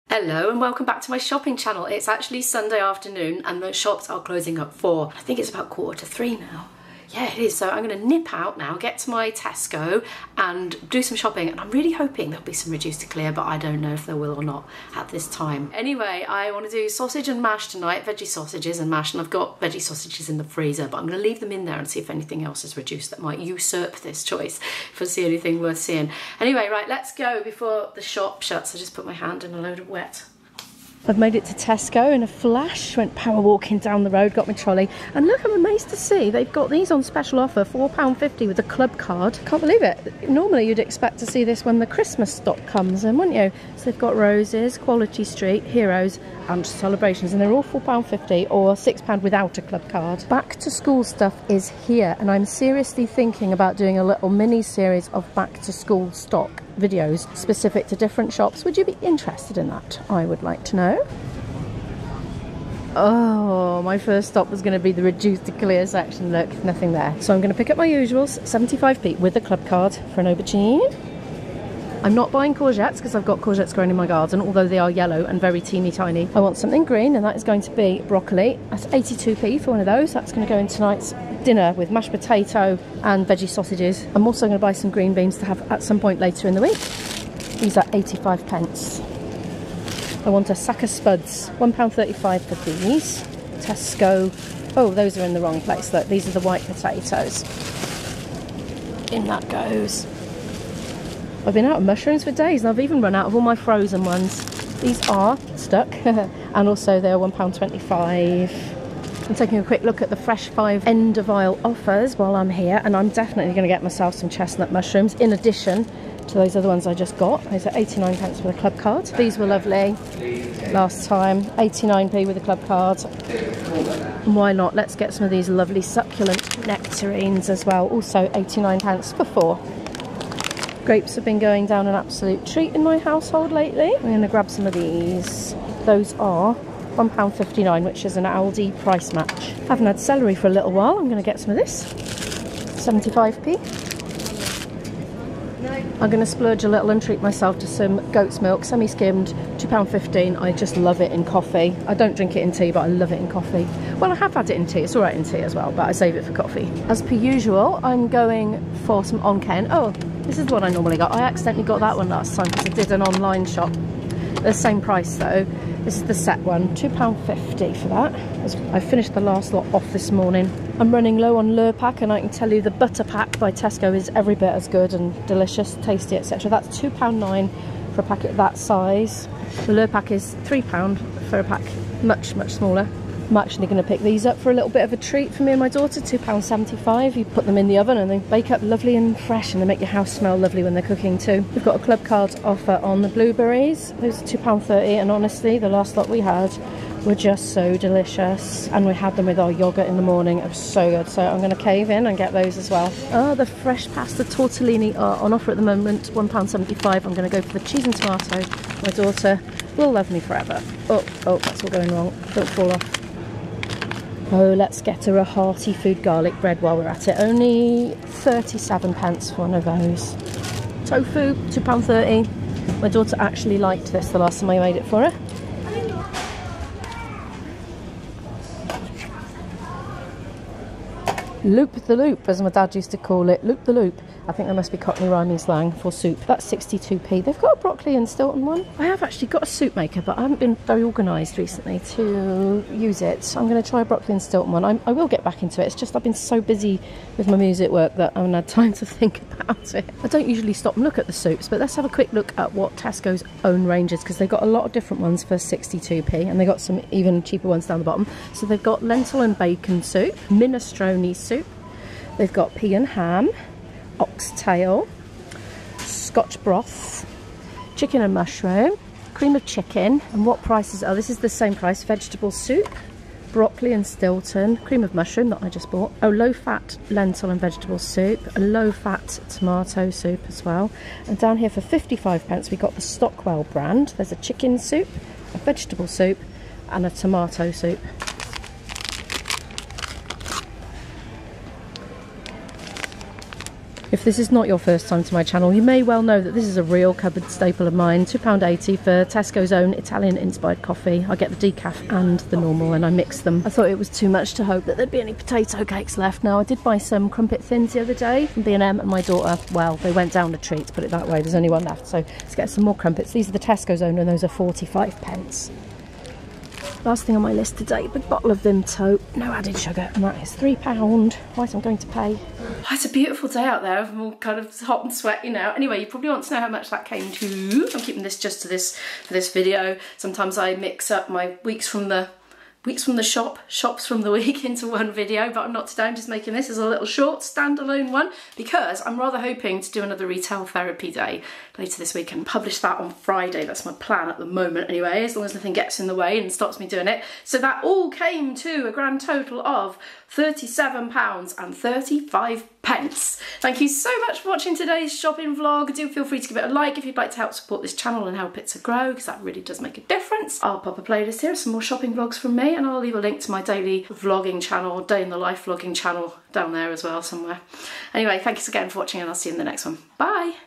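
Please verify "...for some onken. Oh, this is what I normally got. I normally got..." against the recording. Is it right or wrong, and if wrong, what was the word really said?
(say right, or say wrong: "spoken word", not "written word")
wrong: "accidentally", not "normally".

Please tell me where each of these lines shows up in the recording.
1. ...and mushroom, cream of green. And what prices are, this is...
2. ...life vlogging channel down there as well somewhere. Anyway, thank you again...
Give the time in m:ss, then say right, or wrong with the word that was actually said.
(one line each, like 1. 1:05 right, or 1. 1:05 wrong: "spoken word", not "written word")
1. 4:28 wrong: "chicken", not "green"
2. 6:05 right.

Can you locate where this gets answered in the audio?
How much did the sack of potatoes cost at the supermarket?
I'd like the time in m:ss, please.
1:31.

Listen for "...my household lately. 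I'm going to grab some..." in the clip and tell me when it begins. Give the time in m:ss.
2:12.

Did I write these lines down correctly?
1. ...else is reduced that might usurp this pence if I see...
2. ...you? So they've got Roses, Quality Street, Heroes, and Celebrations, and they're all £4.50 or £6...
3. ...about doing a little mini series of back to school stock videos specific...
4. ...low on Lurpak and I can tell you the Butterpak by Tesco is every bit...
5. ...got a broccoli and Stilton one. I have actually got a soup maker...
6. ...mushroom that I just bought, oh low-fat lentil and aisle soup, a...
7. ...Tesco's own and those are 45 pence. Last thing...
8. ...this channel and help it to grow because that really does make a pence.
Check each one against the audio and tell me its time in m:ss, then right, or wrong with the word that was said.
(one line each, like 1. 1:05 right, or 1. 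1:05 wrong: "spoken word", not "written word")
1. 0:22 wrong: "choice", not "pence"
2. 0:43 right
3. 0:53 right
4. 2:51 right
5. 3:57 right
6. 4:34 wrong: "vegetable", not "aisle"
7. 5:13 right
8. 5:57 wrong: "difference", not "pence".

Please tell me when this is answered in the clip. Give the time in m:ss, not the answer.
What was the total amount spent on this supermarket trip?
5:50.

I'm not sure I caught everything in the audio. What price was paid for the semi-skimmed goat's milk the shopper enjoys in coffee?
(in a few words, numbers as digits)
£2.15.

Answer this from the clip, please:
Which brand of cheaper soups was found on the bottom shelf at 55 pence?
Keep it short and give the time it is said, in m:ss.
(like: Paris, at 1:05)
Stockwell, at 4:42.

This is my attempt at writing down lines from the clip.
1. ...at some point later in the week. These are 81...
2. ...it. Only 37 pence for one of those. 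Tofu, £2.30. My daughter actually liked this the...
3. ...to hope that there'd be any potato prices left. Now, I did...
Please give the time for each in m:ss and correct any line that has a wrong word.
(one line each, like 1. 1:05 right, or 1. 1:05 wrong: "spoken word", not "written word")
1. 1:25 wrong: "85", not "81"
2. 3:37 right
3. 5:04 wrong: "cakes", not "prices".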